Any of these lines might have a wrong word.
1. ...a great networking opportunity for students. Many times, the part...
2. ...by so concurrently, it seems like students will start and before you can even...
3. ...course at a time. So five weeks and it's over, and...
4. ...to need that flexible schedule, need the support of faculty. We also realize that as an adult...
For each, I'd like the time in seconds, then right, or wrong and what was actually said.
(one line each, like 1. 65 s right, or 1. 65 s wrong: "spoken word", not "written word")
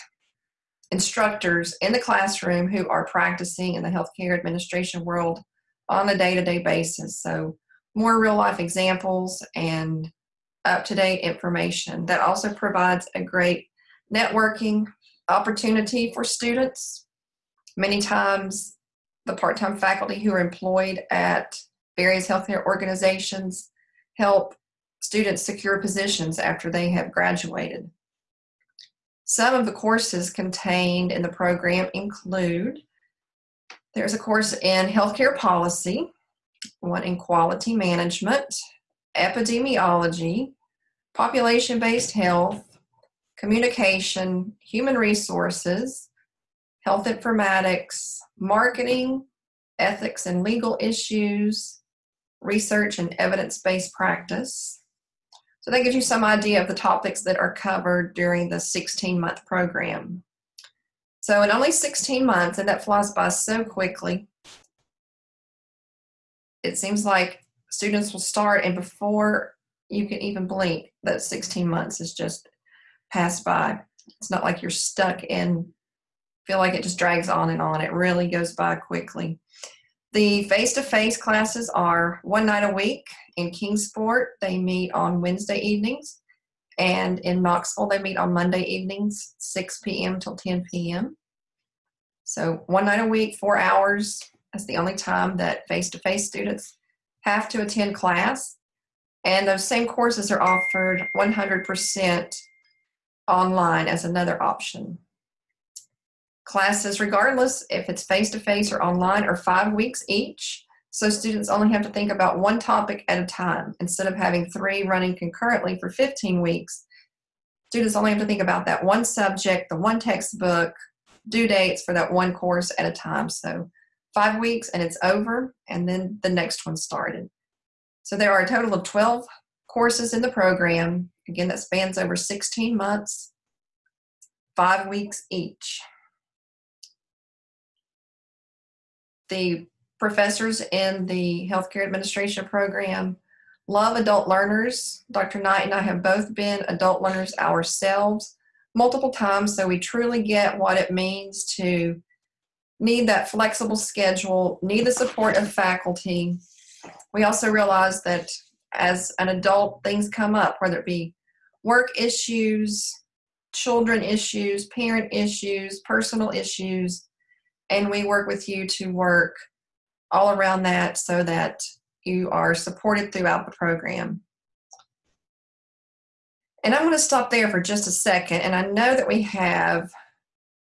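1. 13 s right
2. 63 s wrong: "quickly", not "concurrently"
3. 122 s right
4. 151 s right.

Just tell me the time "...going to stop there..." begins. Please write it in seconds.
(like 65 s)
176 s.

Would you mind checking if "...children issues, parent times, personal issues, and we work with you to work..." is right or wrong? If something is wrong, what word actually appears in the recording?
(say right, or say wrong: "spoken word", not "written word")
wrong: "issues", not "times".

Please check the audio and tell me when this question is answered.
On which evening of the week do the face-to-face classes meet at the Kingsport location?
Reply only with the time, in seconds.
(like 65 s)
85 s.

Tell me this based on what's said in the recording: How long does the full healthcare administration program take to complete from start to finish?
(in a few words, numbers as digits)
16 months.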